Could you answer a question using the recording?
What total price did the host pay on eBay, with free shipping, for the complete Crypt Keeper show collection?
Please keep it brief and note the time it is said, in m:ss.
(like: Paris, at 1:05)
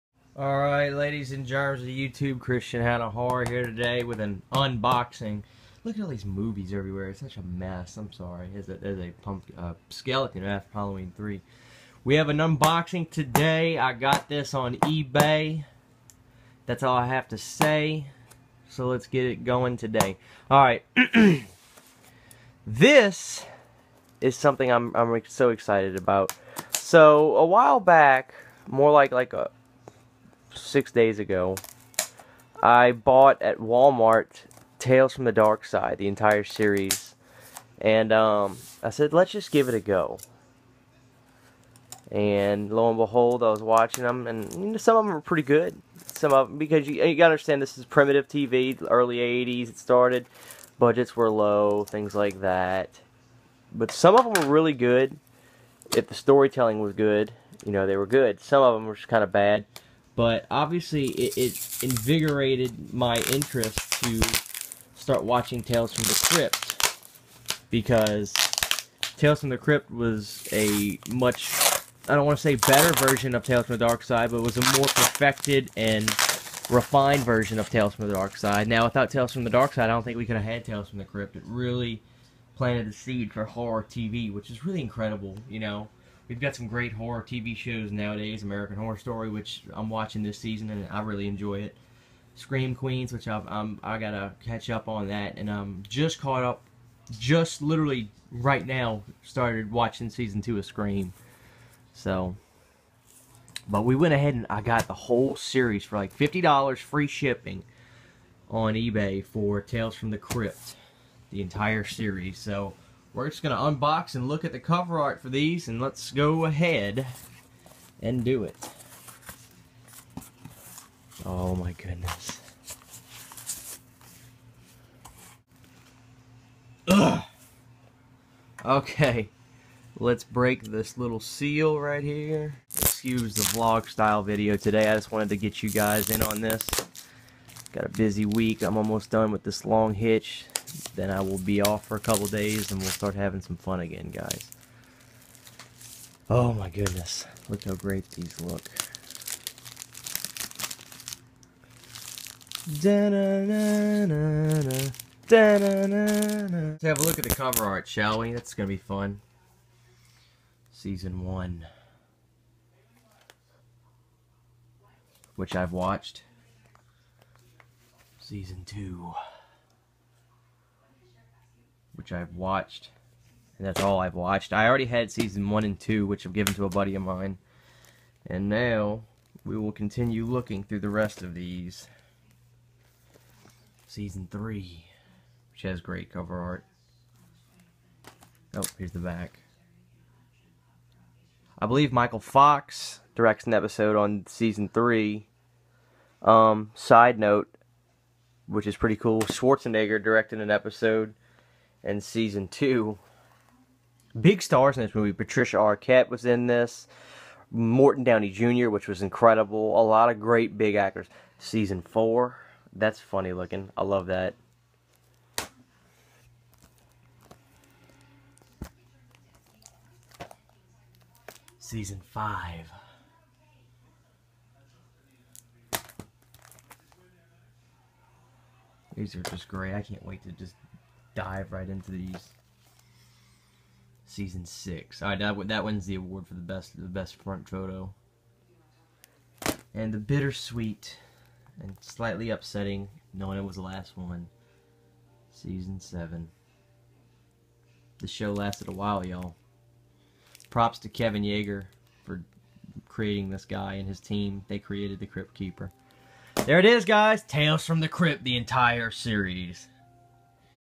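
$50, at 1:46.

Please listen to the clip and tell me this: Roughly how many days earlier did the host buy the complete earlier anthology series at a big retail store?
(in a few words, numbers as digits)
36.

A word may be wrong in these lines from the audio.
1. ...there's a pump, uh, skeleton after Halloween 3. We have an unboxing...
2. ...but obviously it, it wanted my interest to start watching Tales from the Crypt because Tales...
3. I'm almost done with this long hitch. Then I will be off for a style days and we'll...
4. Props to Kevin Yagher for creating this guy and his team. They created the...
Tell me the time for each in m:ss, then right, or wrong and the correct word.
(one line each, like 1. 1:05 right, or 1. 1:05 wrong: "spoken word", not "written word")
1. 0:08 right
2. 1:00 wrong: "invigorated", not "wanted"
3. 2:18 wrong: "couple", not "style"
4. 4:10 right.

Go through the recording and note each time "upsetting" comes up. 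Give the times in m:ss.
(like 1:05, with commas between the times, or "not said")
4:02.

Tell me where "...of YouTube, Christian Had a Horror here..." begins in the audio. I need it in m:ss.
0:01.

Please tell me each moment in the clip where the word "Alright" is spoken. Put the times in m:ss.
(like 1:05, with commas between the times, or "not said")
0:00, 0:20.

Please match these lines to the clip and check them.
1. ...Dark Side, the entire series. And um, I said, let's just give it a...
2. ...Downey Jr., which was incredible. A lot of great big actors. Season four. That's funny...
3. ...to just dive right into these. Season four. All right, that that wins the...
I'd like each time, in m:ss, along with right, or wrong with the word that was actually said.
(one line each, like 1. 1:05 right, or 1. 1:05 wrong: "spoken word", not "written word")
1. 0:35 right
2. 3:28 right
3. 3:50 wrong: "six", not "four".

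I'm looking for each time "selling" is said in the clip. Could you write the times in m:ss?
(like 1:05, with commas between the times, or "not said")
not said.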